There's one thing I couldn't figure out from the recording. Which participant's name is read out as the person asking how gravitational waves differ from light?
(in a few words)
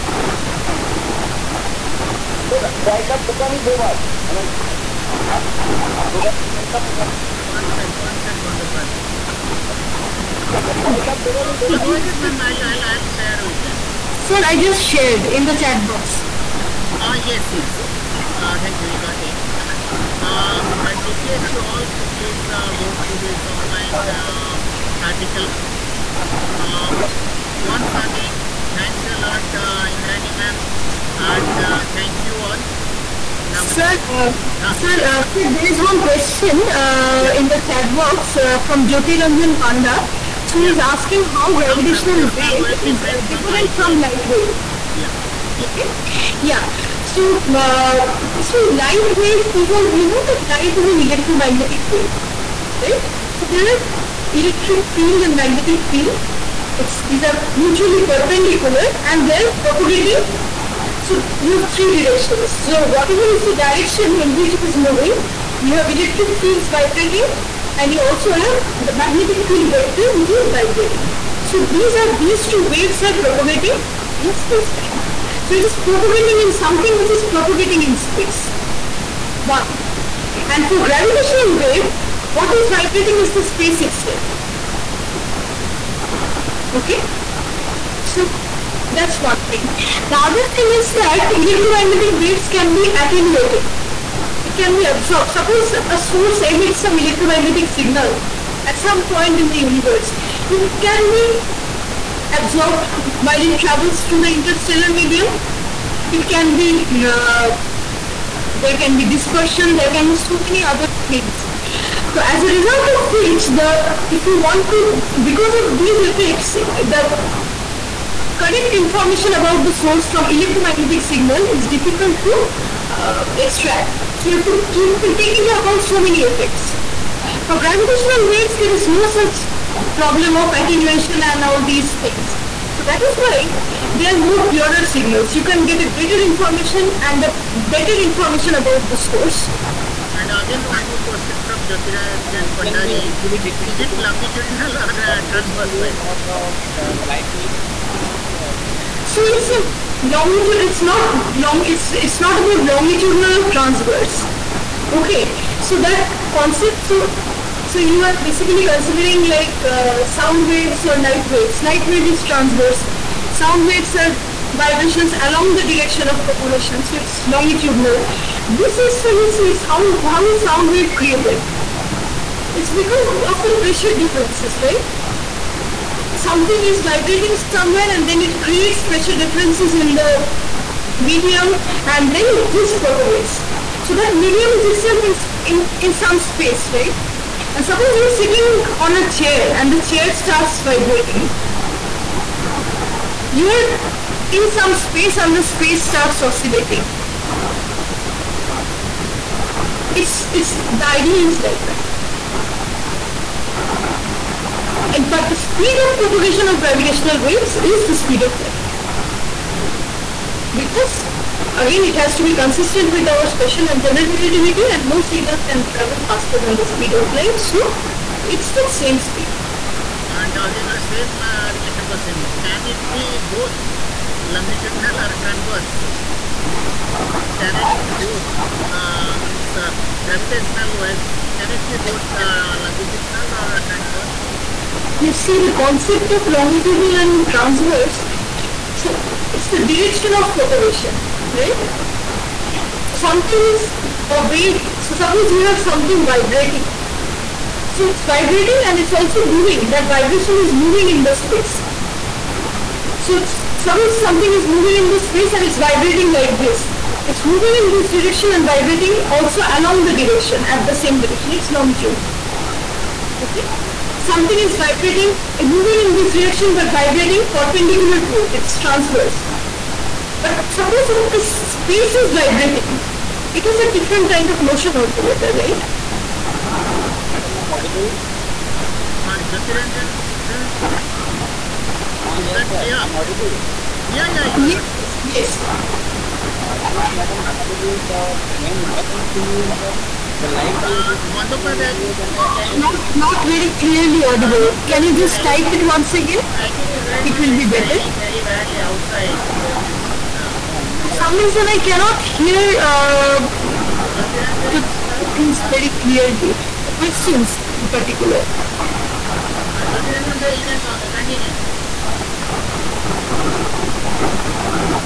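Jyoti Ranjan Panda.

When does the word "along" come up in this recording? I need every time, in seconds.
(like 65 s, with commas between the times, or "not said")
165 s, 259 s.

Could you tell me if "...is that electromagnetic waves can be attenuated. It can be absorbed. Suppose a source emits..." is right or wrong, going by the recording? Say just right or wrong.
right.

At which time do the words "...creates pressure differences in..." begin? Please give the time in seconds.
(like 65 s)
178 s.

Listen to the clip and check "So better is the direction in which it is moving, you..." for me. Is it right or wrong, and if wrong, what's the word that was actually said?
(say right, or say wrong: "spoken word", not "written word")
wrong: "whatever", not "better".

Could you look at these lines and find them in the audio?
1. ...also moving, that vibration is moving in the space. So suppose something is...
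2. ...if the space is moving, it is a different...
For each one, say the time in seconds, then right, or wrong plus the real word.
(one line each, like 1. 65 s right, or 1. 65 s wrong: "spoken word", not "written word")
1. 248 s right
2. 270 s wrong: "vibrating", not "moving".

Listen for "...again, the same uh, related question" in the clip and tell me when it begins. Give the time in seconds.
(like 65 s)
220 s.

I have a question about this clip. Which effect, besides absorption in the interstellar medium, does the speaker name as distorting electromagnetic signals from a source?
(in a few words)
dispersion.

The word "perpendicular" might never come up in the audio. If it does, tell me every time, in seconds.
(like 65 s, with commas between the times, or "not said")
58 s, 267 s.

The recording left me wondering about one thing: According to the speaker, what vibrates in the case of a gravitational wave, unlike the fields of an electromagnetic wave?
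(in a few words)
the space itself.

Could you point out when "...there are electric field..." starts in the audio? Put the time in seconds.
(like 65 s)
53 s.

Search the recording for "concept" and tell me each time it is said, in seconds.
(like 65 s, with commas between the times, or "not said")
156 s, 235 s.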